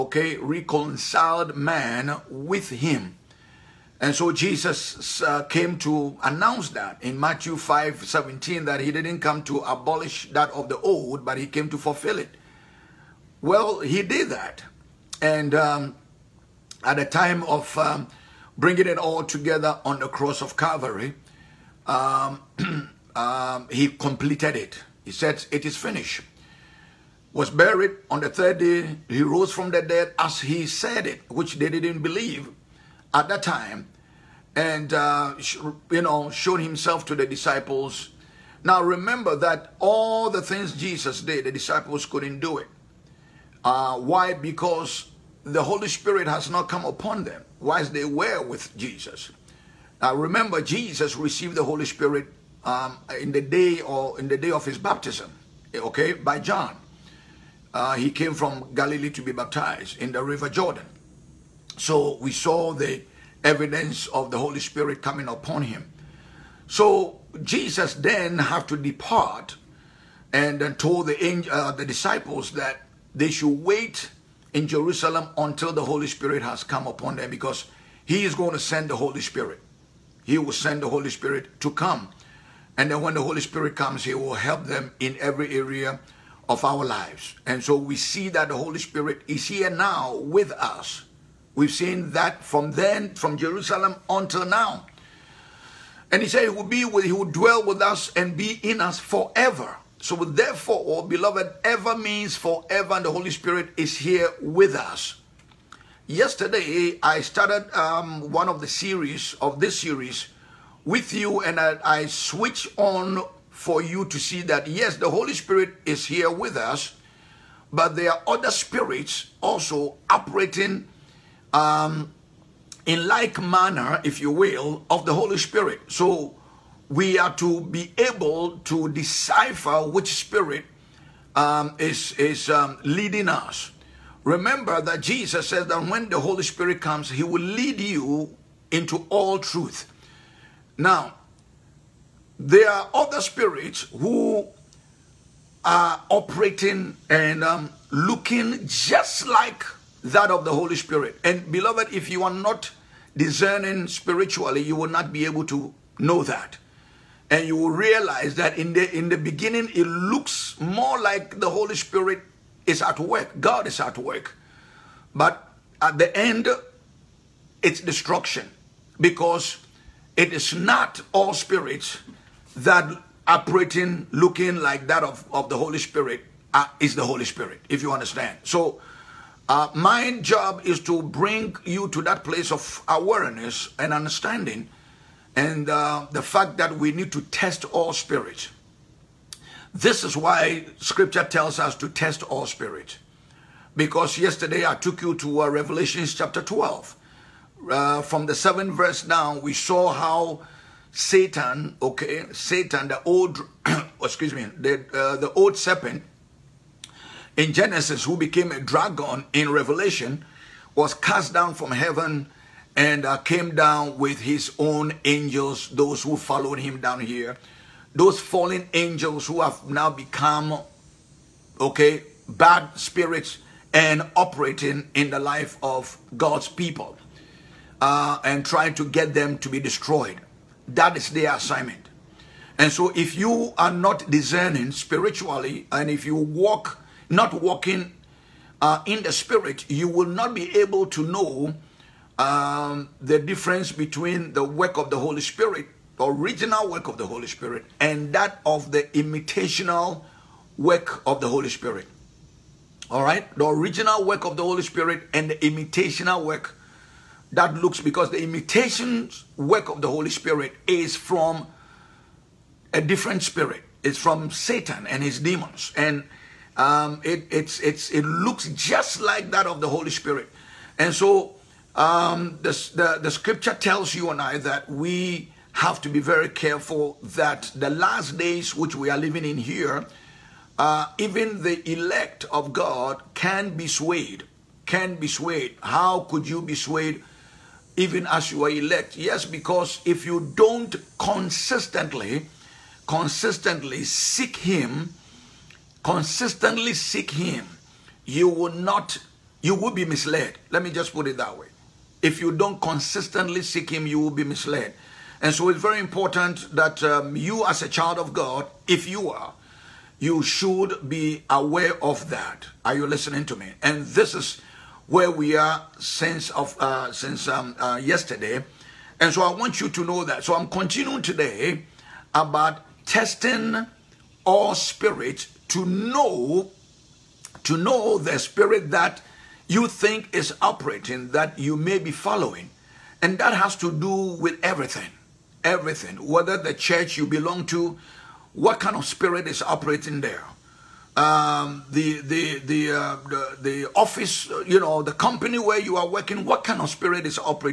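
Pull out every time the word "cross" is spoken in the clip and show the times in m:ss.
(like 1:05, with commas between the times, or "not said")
0:20.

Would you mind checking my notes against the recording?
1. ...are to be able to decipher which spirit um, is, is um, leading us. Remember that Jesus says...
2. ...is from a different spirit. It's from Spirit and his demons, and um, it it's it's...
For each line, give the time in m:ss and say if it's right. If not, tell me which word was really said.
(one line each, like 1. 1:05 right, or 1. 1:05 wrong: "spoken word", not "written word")
1. 2:07 right
2. 4:20 wrong: "Satan", not "Spirit".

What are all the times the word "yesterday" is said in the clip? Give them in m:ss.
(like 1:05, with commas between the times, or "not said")
1:46, 3:14, 5:17.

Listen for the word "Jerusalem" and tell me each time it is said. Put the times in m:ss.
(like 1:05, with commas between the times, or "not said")
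1:14, 1:33.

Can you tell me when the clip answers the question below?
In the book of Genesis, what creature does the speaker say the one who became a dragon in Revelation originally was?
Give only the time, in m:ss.
3:25.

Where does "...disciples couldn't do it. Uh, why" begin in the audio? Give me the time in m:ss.
0:41.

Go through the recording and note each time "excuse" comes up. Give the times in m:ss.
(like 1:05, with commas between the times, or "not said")
3:24.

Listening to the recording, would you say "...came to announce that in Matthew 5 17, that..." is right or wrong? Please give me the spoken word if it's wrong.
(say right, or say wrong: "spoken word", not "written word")
right.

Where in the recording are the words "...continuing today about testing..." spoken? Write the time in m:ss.
5:20.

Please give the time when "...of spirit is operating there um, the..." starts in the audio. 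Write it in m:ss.
5:38.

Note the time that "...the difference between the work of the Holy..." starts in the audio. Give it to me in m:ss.
4:03.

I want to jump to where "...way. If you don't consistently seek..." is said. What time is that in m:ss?
5:01.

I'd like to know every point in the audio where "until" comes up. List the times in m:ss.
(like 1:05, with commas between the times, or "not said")
1:15, 1:34.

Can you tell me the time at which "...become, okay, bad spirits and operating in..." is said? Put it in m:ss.
3:39.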